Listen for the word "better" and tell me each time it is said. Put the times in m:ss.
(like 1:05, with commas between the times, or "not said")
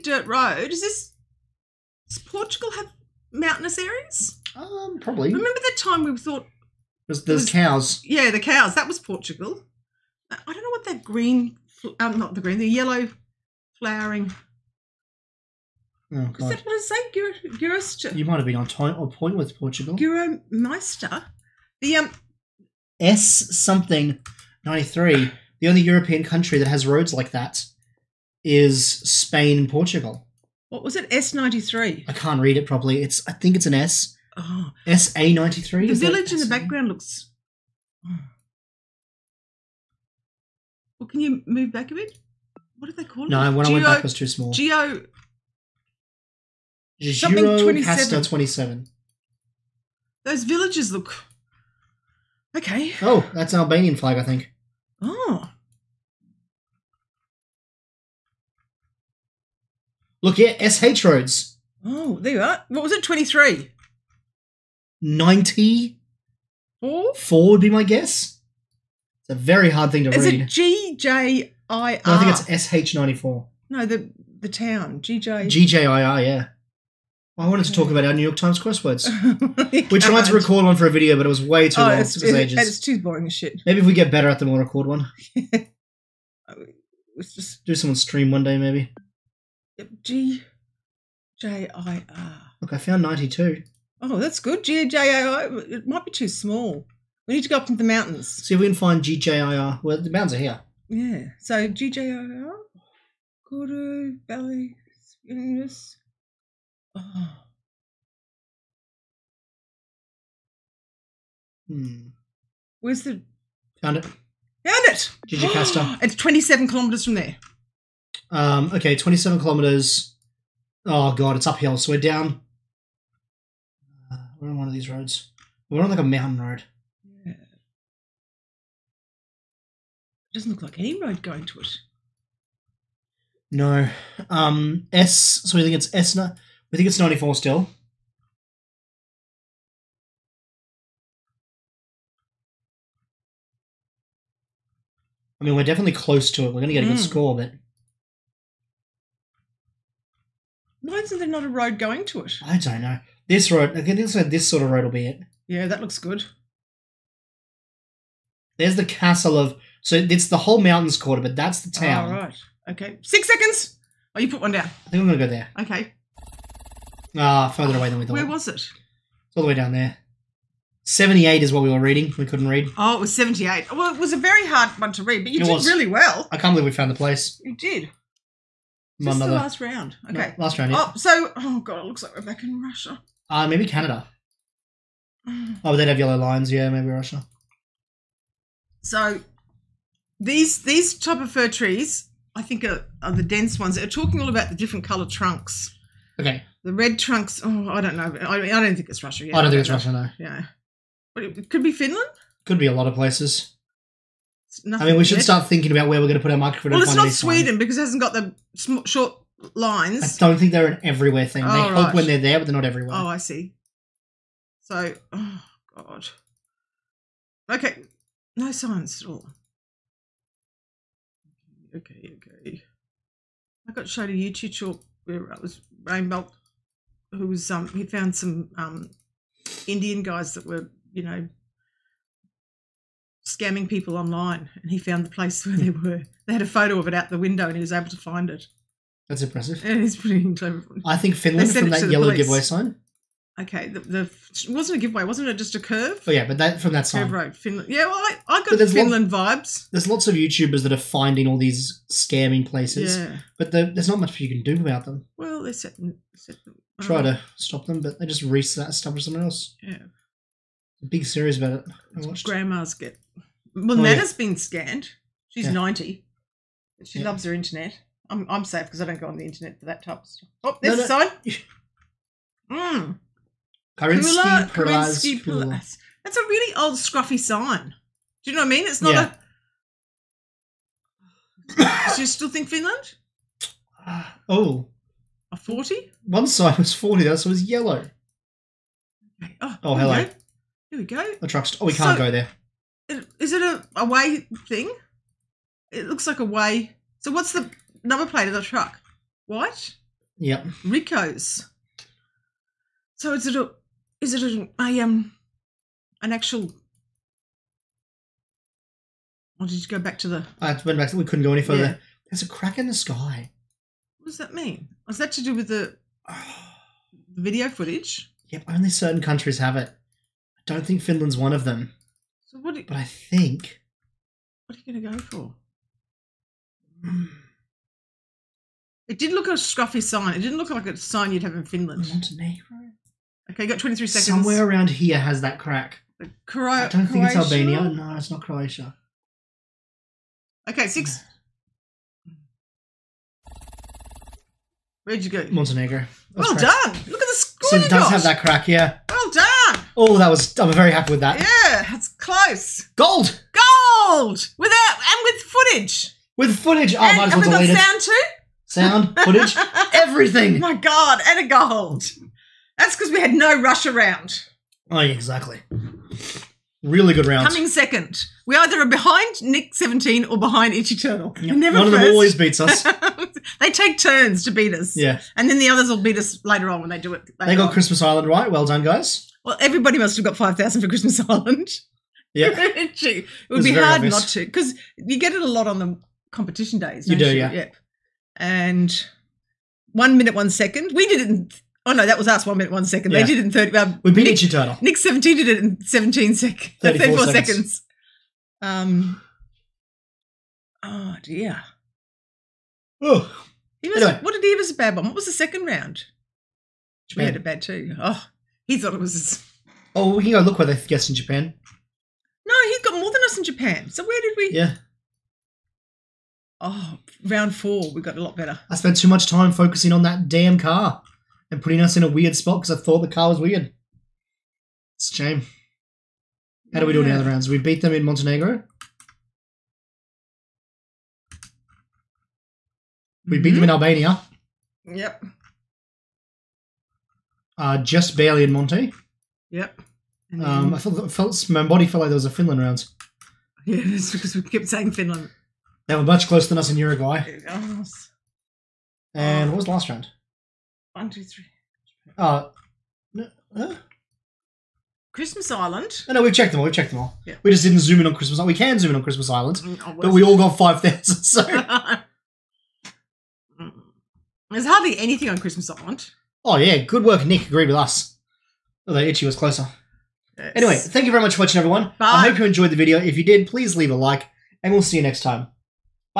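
1:24, 6:58.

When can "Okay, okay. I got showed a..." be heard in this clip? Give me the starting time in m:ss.
3:41.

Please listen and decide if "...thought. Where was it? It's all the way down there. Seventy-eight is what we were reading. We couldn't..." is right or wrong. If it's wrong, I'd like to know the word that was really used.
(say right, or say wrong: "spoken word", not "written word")
right.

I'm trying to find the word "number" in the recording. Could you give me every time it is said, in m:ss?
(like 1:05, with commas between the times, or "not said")
4:57.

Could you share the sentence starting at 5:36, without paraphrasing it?
Cro- I don't think it's Albania.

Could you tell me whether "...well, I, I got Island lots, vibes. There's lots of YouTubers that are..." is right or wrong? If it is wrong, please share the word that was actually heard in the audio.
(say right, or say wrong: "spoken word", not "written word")
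wrong: "Finland", not "Island".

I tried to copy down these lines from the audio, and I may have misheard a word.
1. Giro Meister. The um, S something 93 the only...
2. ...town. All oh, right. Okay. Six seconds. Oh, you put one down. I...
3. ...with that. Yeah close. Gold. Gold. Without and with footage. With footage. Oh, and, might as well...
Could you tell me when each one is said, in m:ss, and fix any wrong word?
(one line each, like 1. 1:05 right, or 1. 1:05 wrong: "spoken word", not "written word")
1. 0:19 right
2. 2:41 right
3. 5:50 right.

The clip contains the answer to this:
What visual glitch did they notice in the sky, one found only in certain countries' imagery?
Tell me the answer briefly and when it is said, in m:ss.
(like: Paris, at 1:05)
a crack, at 5:12.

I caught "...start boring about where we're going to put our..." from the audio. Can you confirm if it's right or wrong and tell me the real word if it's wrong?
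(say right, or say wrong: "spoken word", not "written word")
wrong: "thinking", not "boring".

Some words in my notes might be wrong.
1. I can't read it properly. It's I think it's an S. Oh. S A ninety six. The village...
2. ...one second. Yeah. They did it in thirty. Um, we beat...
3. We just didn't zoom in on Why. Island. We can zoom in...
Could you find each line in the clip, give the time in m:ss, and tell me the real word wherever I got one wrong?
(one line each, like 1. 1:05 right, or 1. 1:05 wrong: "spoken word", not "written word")
1. 0:32 wrong: "three", not "six"
2. 6:32 right
3. 7:37 wrong: "Christmas", not "Why".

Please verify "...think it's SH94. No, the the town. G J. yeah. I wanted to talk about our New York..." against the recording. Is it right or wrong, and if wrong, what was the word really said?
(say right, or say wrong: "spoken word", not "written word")
right.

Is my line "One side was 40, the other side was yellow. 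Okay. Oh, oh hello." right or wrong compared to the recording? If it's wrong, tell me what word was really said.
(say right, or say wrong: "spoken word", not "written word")
right.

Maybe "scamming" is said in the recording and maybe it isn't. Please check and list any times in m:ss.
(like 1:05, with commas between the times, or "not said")
3:53, 4:11.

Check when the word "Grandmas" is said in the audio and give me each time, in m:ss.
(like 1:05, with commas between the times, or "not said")
4:22.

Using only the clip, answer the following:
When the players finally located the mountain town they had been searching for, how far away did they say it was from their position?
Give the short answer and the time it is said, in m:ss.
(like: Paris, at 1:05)
27 kilometres, at 1:56.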